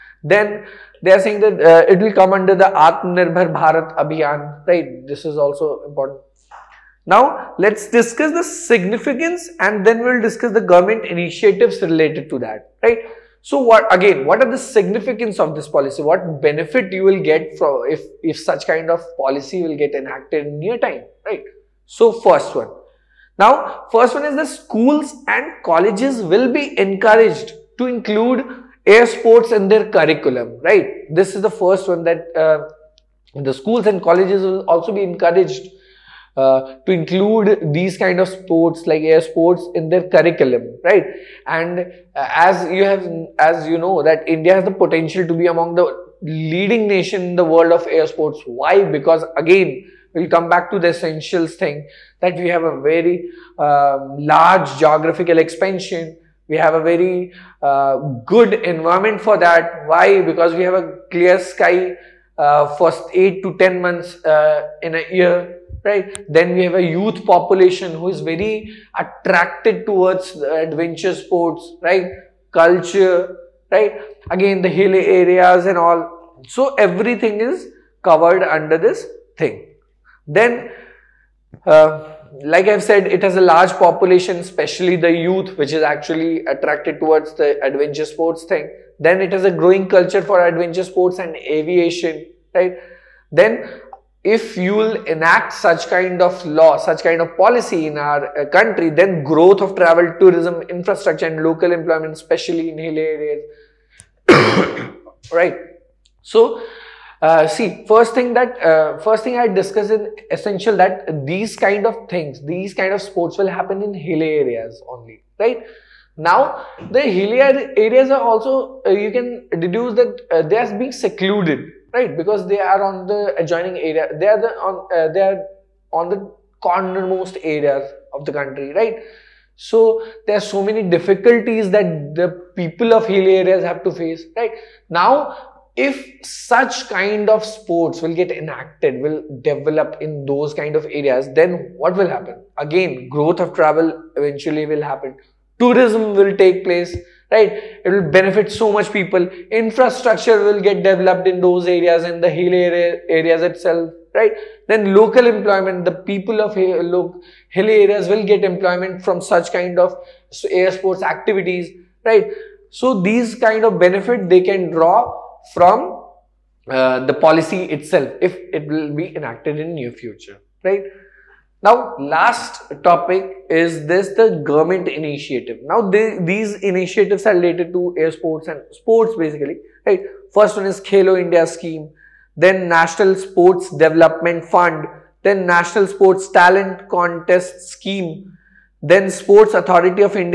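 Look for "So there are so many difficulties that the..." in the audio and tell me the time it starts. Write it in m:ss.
2:09.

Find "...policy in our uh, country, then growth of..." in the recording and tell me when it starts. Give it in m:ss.
1:37.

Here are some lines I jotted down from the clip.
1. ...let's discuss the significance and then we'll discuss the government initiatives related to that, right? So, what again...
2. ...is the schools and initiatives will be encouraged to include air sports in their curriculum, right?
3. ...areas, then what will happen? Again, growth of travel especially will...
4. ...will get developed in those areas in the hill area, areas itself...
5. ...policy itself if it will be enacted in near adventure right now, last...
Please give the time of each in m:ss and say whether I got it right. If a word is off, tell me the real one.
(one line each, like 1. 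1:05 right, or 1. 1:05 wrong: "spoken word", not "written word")
1. 0:07 right
2. 0:24 wrong: "colleges", not "initiatives"
3. 2:20 wrong: "eventually", not "especially"
4. 2:30 right
5. 2:47 wrong: "future", not "adventure".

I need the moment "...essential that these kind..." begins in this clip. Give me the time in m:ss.
1:50.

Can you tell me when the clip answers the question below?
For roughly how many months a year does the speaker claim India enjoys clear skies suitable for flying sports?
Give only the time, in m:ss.
1:03.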